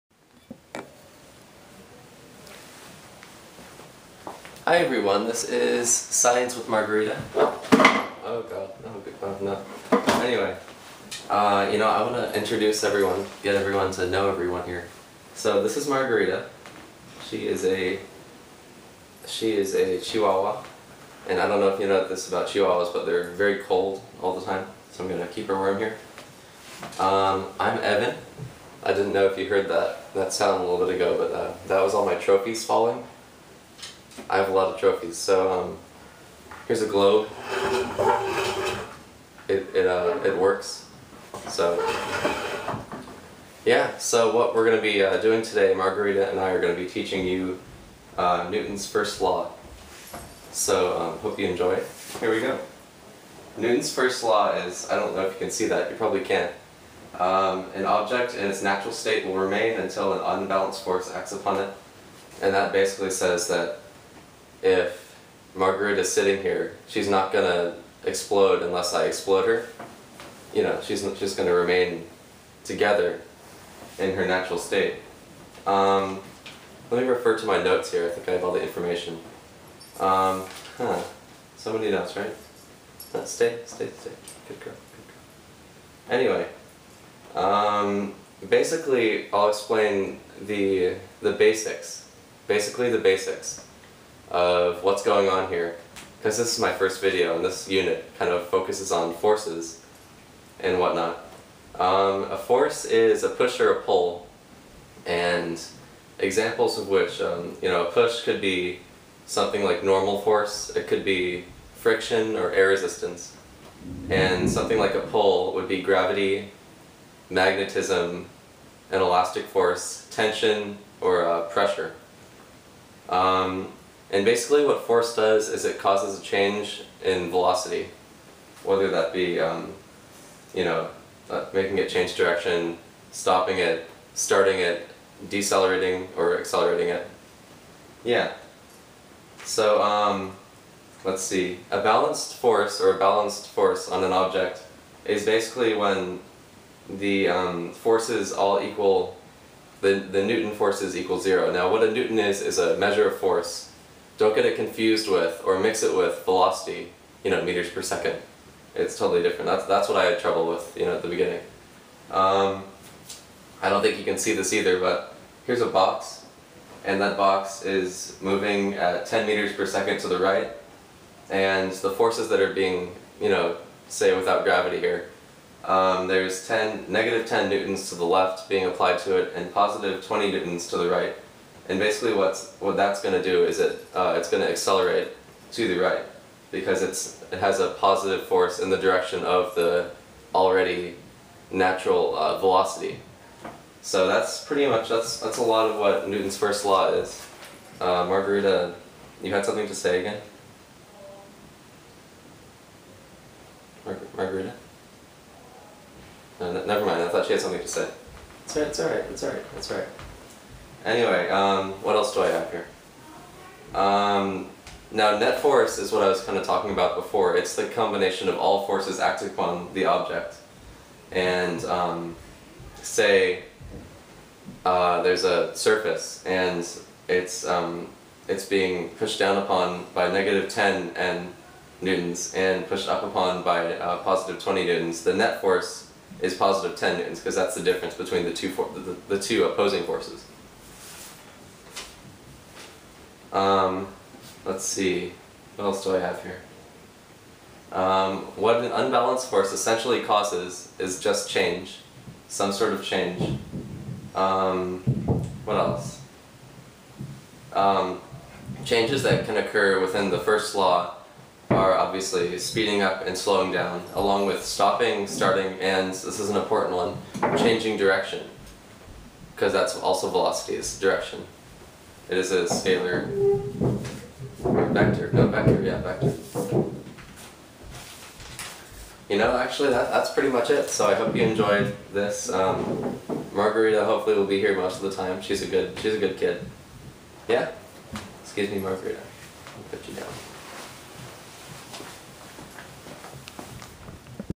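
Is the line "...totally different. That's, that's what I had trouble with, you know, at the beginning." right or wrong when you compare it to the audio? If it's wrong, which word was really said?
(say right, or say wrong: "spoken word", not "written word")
right.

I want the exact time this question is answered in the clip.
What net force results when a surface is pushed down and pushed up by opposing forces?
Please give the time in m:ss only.
3:56.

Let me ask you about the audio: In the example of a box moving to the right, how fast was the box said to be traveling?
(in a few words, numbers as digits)
10 meters per second.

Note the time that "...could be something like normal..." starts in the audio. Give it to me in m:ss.
1:48.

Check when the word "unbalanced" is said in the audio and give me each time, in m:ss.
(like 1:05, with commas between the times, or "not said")
1:00, 4:08.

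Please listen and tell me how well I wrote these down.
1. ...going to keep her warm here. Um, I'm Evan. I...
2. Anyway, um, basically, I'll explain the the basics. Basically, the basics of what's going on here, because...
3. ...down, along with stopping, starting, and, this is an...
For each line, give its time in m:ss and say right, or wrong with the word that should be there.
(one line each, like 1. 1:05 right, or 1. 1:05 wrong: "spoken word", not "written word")
1. 0:25 right
2. 1:26 right
3. 4:23 right.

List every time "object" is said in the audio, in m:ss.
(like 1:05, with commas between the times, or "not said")
0:57, 2:24, 3:39.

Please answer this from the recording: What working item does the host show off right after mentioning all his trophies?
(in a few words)
a globe.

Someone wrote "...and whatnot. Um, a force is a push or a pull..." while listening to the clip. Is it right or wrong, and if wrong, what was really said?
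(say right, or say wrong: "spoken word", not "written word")
right.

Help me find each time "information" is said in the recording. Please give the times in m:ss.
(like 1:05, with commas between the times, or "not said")
1:18.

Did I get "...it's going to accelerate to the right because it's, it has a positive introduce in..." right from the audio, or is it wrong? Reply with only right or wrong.
wrong.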